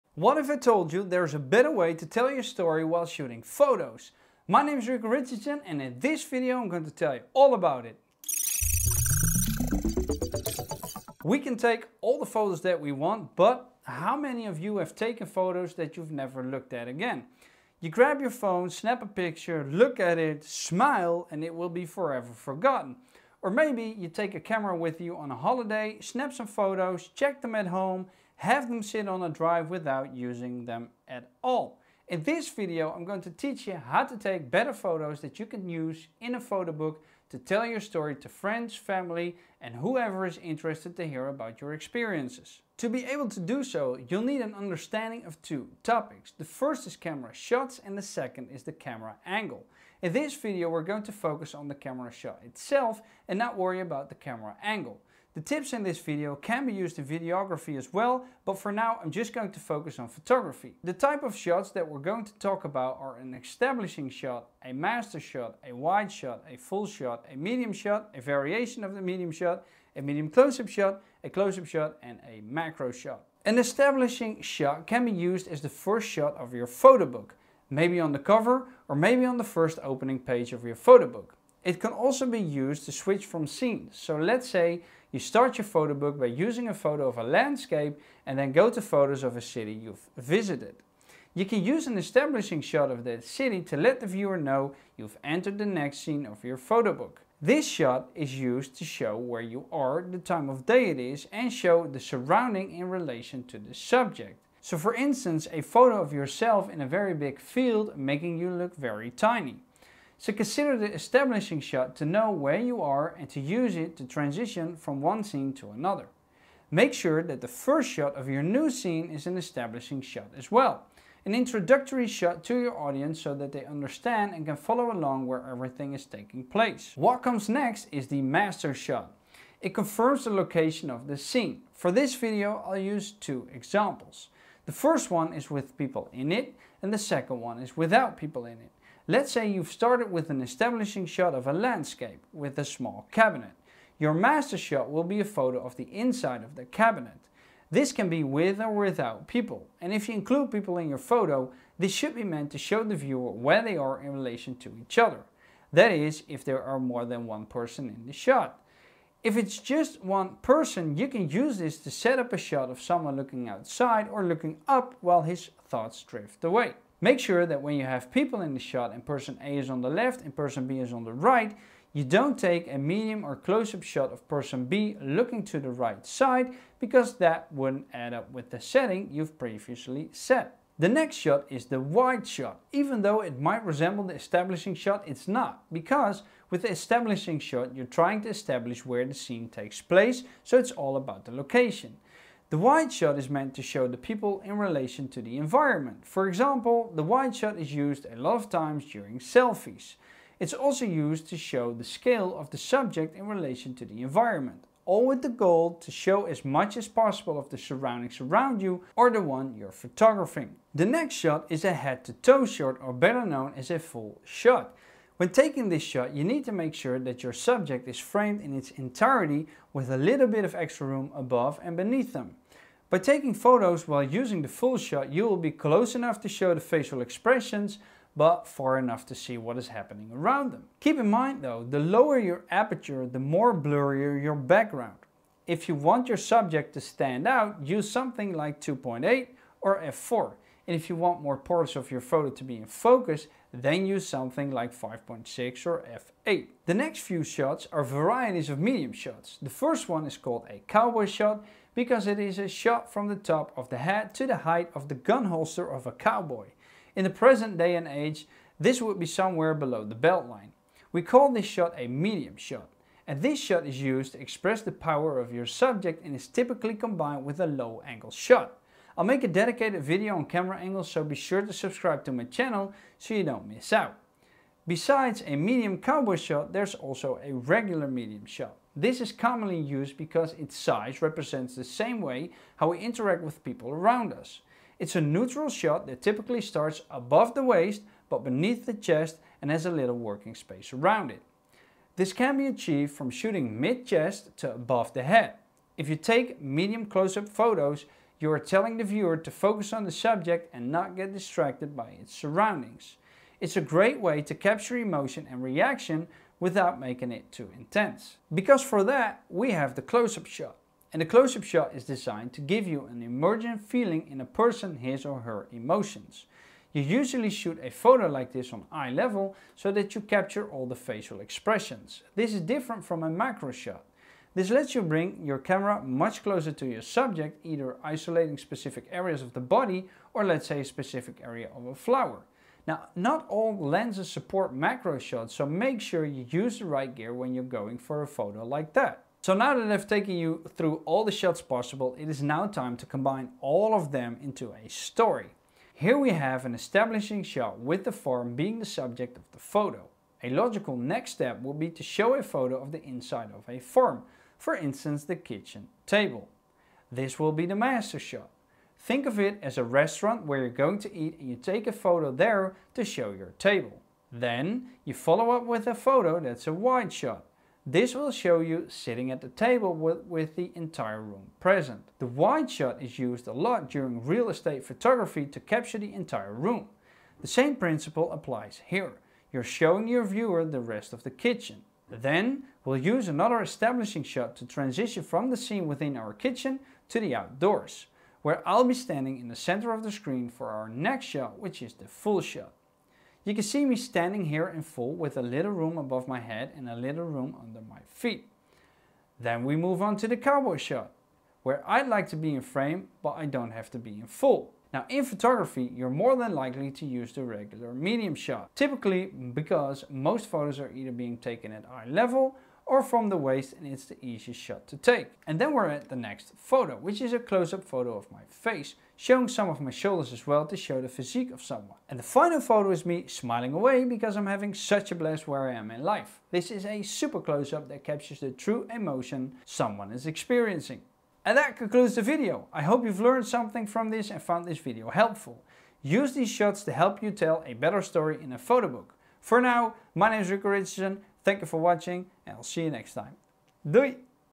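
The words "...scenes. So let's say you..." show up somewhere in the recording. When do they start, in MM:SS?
01:23.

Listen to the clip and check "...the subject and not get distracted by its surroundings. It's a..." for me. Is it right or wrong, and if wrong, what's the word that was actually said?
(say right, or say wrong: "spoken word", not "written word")
right.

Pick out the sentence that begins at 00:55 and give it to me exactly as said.
The tips in this video can be used in videography as well, but for now I'm just going to focus on photography.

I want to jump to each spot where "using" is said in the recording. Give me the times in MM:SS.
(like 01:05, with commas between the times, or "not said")
00:30, 01:26, 03:44.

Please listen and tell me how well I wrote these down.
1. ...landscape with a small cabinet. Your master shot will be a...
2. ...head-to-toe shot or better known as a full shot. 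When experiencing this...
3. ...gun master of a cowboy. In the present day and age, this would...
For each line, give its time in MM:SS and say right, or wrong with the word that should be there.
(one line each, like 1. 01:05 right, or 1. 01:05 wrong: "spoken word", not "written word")
1. 02:21 right
2. 03:31 wrong: "taking", not "experiencing"
3. 04:14 wrong: "holster", not "master".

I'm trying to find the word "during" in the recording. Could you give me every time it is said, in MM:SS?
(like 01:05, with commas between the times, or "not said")
03:18, 06:13.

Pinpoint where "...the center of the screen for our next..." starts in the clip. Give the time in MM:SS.
06:29.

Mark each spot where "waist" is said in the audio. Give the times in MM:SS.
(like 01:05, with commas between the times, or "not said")
04:47, 06:53.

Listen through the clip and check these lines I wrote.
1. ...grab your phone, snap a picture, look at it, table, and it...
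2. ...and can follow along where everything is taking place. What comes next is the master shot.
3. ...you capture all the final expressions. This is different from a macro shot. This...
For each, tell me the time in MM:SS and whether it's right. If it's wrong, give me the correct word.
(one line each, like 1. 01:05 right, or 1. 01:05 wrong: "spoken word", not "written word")
1. 00:17 wrong: "smile", not "table"
2. 02:04 right
3. 05:19 wrong: "facial", not "final".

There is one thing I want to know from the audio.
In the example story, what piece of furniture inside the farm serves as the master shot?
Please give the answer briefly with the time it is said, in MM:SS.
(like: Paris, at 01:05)
kitchen table, at 05:55.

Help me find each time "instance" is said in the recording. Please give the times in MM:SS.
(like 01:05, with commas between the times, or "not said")
01:44, 05:54.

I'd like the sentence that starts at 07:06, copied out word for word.
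This is a super close-up that captures the true emotion someone is experiencing.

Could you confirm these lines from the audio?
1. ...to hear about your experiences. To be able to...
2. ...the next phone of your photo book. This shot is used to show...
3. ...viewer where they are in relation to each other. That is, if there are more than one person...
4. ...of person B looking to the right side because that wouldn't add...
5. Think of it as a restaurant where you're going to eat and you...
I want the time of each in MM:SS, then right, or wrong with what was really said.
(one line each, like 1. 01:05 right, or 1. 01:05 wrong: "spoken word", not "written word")
1. 00:40 right
2. 01:35 wrong: "scene", not "phone"
3. 02:32 right
4. 02:54 right
5. 05:58 right.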